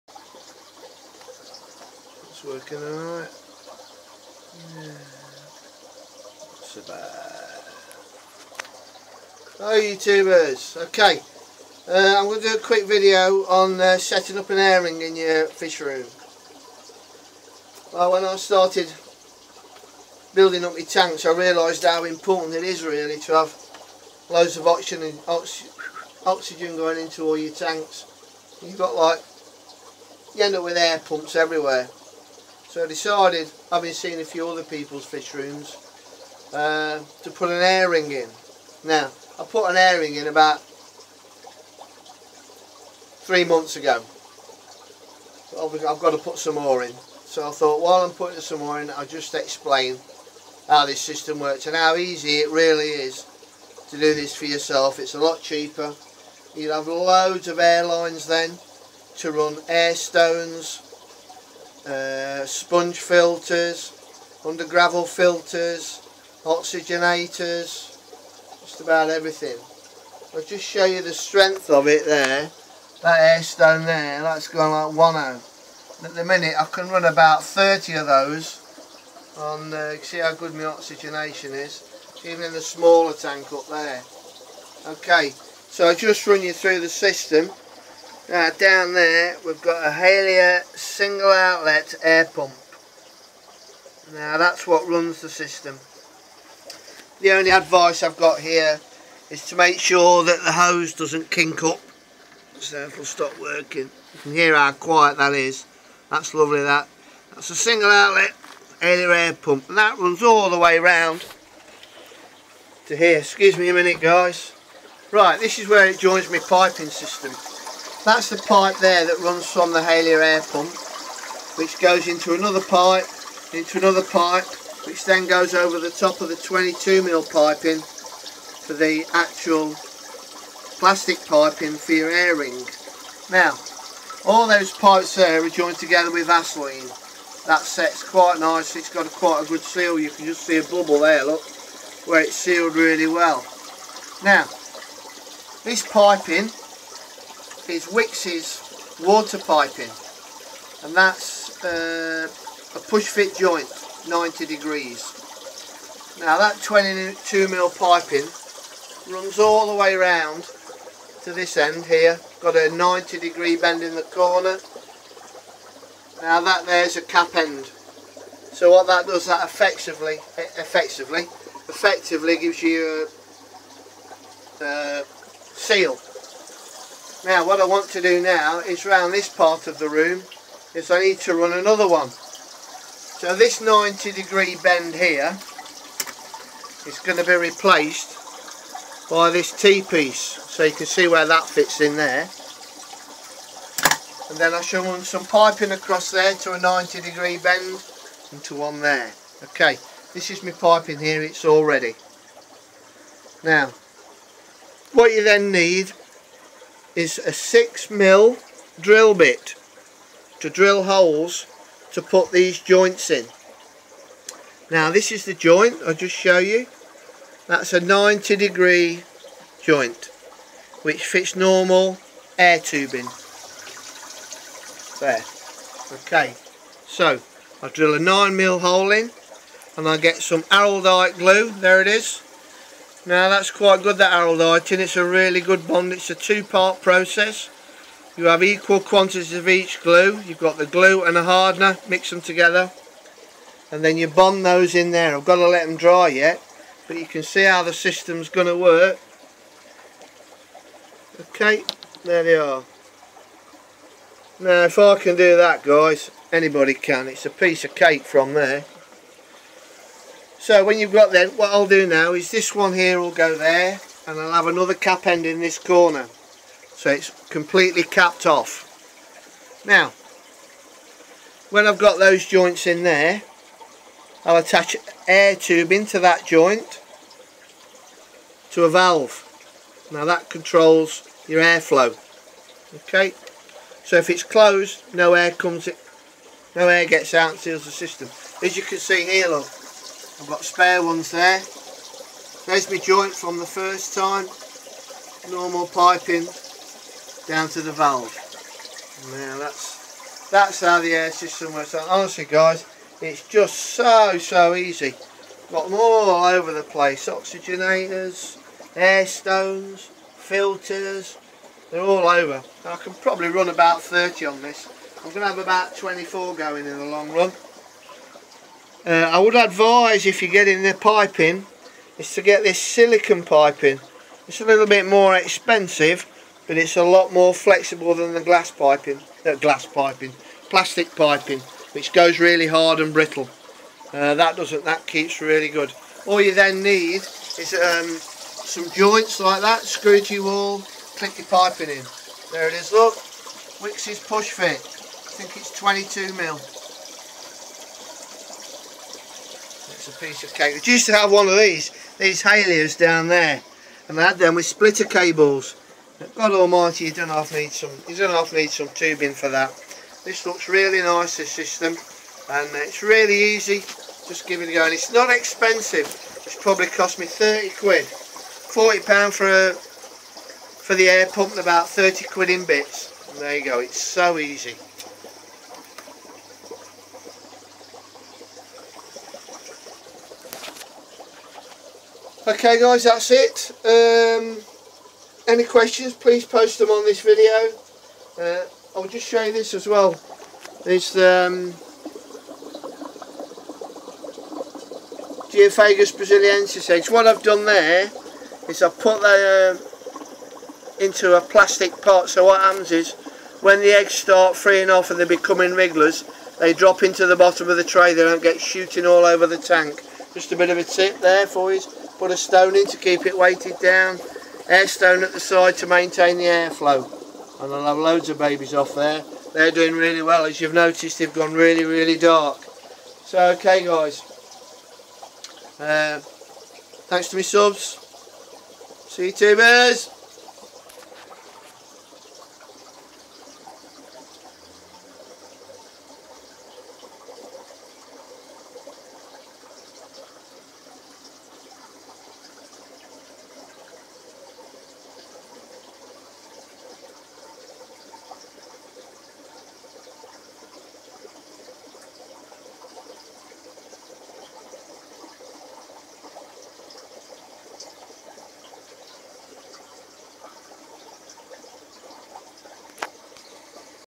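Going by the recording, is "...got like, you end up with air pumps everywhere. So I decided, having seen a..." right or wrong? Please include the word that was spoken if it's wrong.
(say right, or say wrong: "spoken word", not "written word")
right.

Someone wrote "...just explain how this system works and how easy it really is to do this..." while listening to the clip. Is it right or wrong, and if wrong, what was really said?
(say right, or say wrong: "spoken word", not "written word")
right.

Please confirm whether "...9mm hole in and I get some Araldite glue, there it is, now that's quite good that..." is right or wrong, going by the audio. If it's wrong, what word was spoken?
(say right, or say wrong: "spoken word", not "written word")
right.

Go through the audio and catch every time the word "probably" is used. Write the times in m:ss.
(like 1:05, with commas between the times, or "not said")
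5:12, 6:06.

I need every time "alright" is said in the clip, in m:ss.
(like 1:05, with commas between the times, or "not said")
0:02.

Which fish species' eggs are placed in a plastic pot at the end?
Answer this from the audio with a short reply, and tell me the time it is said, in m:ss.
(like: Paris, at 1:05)
Geophagus brasiliensis, at 6:35.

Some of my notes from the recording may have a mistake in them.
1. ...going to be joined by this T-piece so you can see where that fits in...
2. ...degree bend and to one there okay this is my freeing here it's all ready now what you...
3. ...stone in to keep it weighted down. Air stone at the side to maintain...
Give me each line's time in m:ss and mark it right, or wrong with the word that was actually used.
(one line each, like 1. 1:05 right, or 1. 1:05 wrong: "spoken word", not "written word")
1. 3:07 wrong: "replaced", not "joined"
2. 3:17 wrong: "piping", not "freeing"
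3. 6:52 right.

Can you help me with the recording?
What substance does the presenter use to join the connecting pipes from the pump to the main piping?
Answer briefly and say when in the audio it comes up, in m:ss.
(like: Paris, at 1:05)
Vaseline, at 2:16.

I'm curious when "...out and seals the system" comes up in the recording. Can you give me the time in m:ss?
4:47.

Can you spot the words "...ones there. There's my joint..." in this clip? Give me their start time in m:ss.
4:50.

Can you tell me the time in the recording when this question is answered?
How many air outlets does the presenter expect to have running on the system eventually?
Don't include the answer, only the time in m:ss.
5:15.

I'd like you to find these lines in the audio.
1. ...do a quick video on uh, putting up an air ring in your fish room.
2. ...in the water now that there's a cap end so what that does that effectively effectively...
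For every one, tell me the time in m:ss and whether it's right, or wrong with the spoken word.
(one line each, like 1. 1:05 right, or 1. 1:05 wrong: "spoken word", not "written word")
1. 0:12 wrong: "setting", not "putting"
2. 2:43 wrong: "corner", not "water".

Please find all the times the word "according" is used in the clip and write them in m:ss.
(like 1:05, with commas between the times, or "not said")
not said.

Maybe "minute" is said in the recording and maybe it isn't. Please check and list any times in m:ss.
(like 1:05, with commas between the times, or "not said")
1:16, 1:53.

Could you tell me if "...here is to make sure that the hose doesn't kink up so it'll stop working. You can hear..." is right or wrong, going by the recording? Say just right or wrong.
right.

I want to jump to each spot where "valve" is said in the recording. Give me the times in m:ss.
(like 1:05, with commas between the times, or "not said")
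4:38, 4:57.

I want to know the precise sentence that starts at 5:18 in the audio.
Uh, I would advise if you're getting the piping is to get this silicon piping.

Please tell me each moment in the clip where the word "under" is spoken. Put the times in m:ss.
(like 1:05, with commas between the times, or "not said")
1:04.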